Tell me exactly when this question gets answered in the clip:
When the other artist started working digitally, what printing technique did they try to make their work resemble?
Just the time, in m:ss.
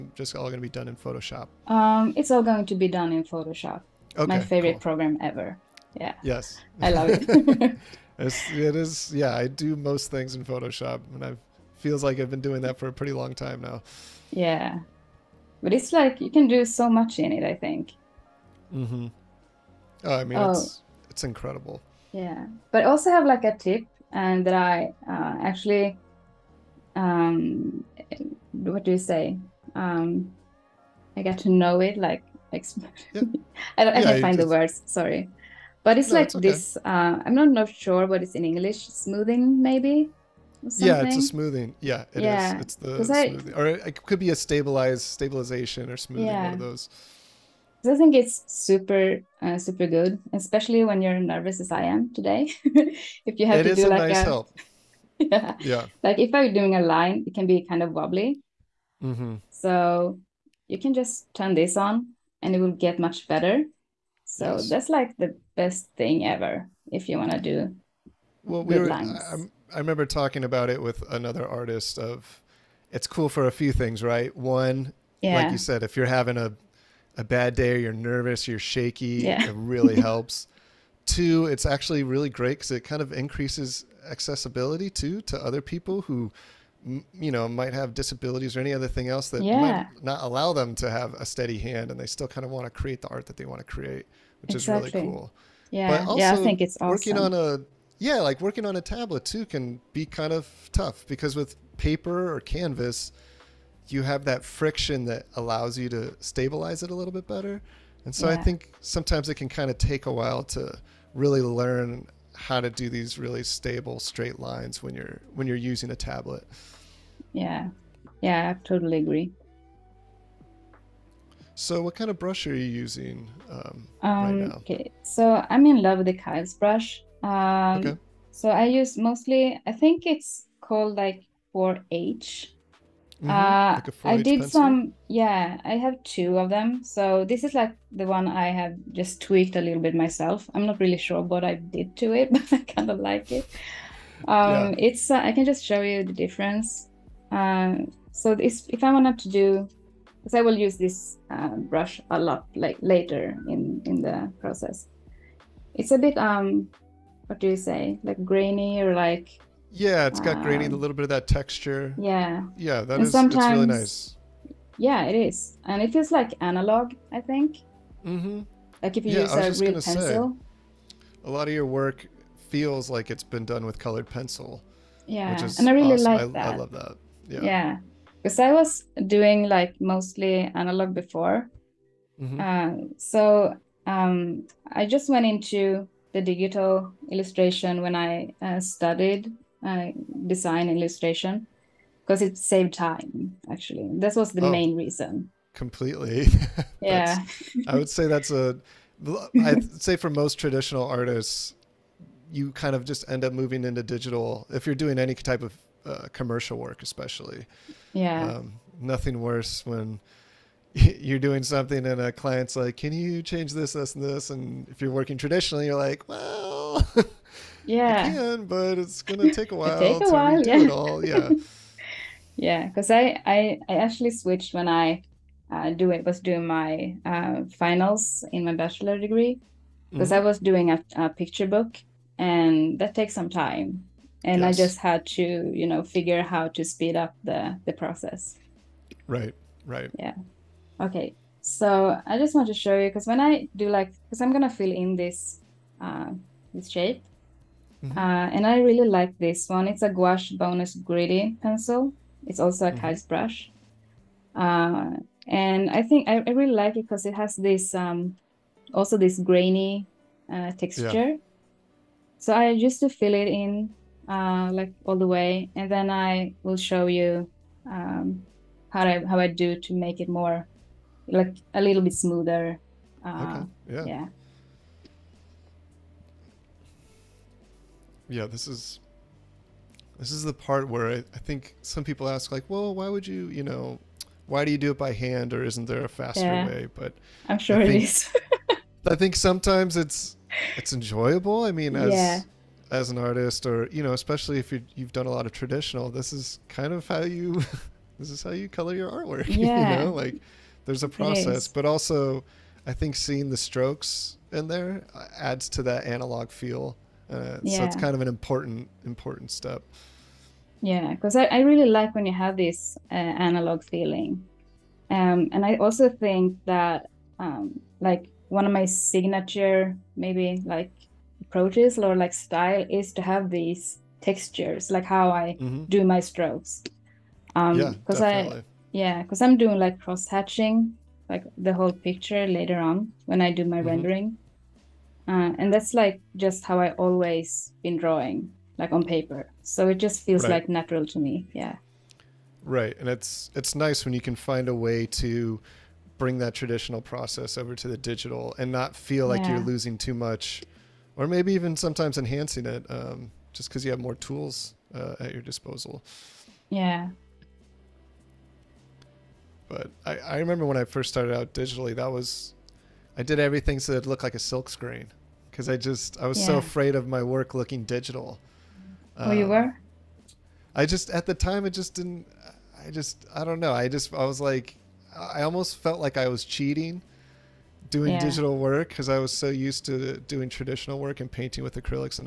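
6:04.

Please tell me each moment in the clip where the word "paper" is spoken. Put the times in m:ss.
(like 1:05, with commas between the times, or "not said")
1:41, 5:38.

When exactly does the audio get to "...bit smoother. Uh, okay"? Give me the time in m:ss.
4:31.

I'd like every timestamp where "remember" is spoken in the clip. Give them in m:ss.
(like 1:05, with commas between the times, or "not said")
1:09, 6:00.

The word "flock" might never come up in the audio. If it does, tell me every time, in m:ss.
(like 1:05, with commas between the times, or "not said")
not said.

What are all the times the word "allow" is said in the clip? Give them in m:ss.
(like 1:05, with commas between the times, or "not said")
1:30, 1:45.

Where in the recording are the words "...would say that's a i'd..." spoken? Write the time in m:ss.
3:17.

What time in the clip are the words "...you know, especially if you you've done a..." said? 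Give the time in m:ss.
4:53.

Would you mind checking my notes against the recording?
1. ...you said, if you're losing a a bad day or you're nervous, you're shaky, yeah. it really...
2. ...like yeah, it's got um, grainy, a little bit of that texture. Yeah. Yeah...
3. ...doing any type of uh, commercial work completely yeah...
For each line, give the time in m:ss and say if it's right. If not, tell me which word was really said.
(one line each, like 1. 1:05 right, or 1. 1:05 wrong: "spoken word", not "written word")
1. 1:15 wrong: "having", not "losing"
2. 2:38 right
3. 3:24 wrong: "especially", not "completely".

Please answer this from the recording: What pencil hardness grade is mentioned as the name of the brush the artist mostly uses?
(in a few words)
4H.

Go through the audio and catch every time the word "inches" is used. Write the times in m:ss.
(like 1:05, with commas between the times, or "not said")
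not said.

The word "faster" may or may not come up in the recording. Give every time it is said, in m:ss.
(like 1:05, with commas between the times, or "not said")
4:45.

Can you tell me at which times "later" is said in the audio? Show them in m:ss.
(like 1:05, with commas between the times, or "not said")
2:32, 5:32.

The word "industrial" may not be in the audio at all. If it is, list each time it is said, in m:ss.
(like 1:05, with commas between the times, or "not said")
not said.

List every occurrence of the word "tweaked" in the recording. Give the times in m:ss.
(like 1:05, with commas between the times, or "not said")
2:19.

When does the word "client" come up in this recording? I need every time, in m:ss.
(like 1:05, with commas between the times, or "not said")
3:32.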